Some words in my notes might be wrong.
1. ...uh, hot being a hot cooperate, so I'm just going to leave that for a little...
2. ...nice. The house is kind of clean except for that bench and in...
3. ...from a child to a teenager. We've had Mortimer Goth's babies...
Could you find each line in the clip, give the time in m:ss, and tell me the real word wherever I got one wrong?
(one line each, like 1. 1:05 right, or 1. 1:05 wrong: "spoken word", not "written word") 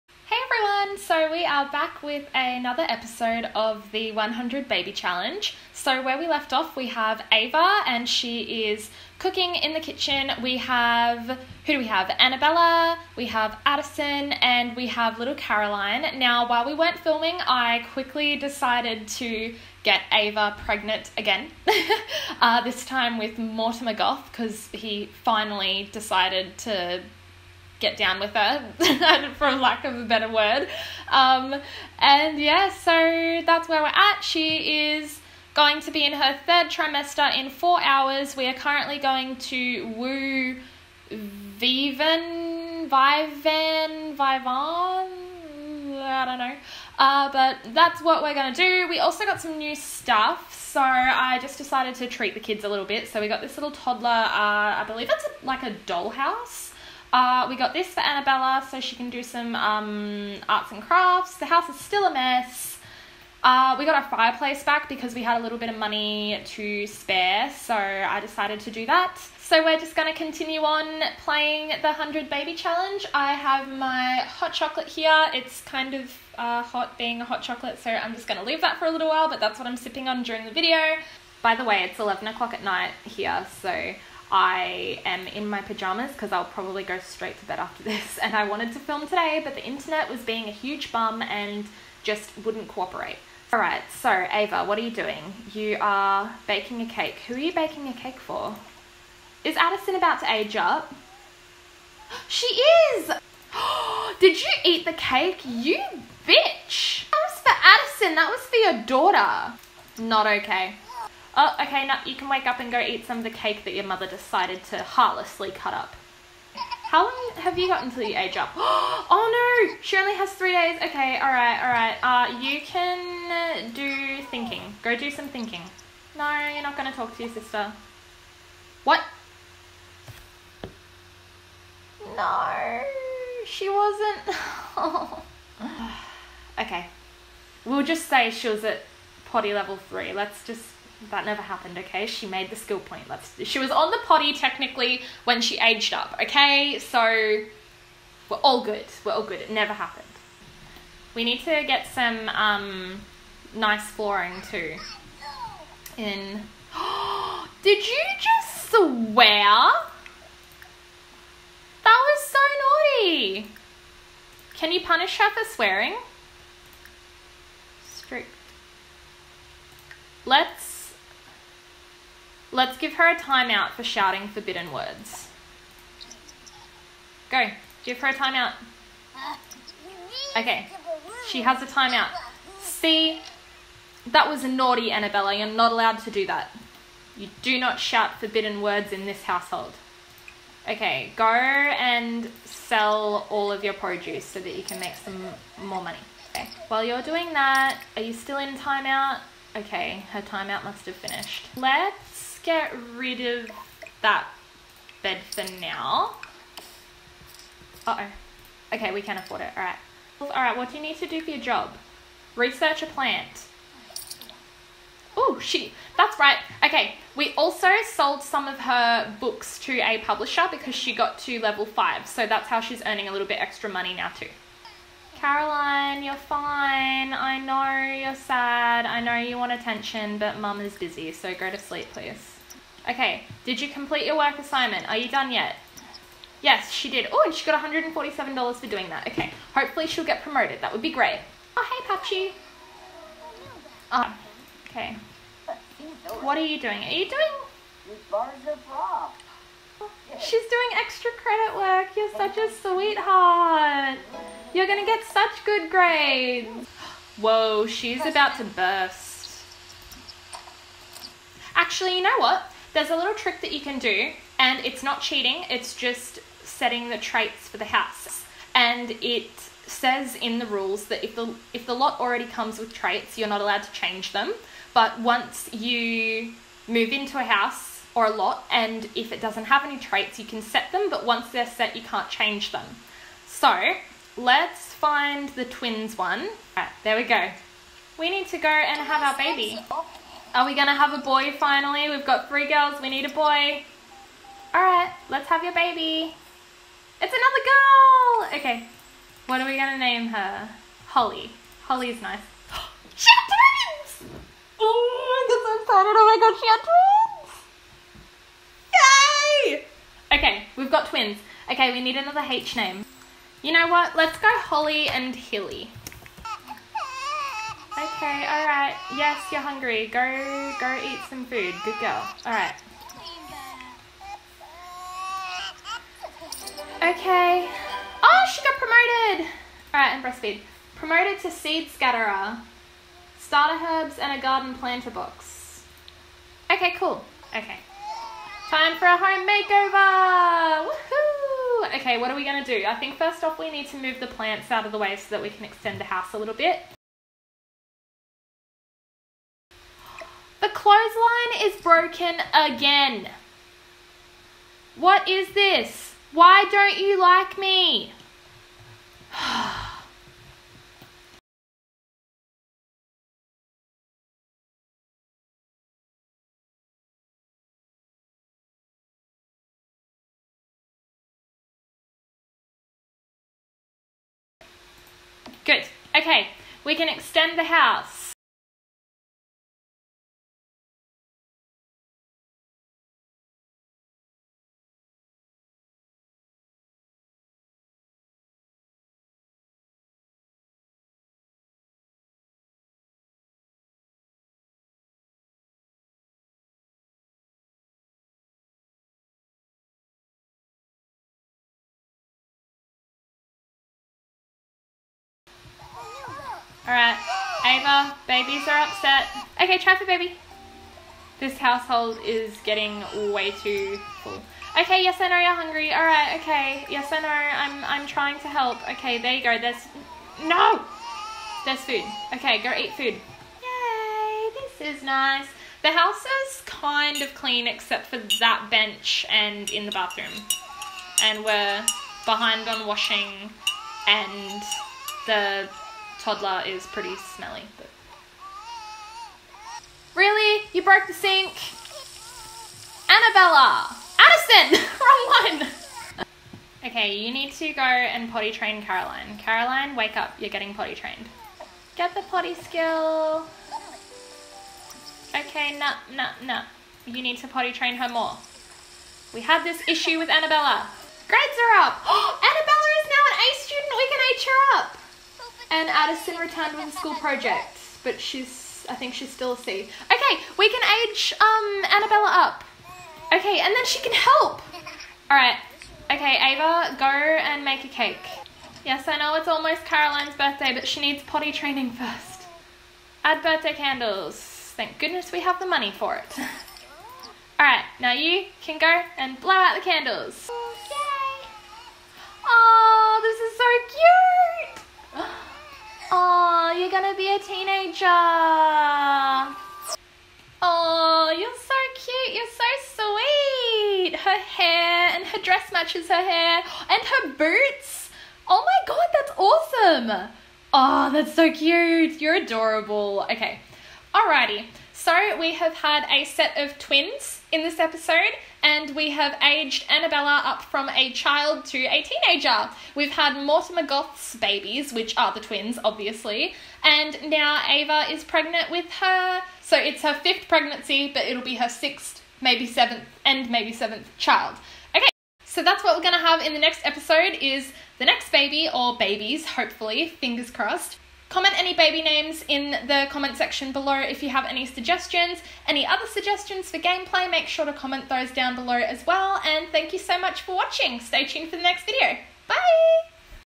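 1. 1:16 wrong: "chocolate", not "cooperate"
2. 7:04 right
3. 8:40 right.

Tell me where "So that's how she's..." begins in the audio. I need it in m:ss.
3:42.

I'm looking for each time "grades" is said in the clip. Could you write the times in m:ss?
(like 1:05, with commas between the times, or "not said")
4:15, 7:41.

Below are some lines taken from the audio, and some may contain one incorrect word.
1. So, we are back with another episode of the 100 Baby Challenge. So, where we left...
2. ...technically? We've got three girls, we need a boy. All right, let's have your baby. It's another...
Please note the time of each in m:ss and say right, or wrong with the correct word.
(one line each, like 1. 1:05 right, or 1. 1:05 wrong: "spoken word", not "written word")
1. 0:01 right
2. 4:51 wrong: "finally", not "technically".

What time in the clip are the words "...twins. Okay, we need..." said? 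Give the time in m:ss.
5:10.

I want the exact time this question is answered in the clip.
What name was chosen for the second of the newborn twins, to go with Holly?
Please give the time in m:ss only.
5:15.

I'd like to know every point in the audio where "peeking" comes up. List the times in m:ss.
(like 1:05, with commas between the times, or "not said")
not said.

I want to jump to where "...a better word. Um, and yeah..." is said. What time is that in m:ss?
0:29.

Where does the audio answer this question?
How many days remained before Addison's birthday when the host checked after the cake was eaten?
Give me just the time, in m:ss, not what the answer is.
2:00.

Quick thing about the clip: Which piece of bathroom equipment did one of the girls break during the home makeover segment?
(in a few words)
The sink.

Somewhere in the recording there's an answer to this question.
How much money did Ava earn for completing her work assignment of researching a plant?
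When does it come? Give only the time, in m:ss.
3:57.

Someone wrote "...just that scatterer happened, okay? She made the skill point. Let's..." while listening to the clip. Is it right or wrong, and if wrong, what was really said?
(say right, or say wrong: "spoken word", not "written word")
wrong: "never", not "scatterer".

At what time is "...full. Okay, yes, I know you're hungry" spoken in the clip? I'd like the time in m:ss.
6:54.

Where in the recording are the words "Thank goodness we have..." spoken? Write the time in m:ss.
8:04.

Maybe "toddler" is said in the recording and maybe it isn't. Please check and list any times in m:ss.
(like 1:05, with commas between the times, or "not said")
0:53, 7:16.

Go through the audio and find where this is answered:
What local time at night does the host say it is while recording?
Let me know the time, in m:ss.
1:21.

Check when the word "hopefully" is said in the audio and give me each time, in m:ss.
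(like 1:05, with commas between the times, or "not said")
3:59, 8:59.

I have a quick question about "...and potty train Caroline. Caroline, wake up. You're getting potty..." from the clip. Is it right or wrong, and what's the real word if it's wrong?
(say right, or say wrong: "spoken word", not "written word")
right.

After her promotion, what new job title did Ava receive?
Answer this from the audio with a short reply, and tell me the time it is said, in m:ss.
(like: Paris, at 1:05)
Seed scatterer, at 5:31.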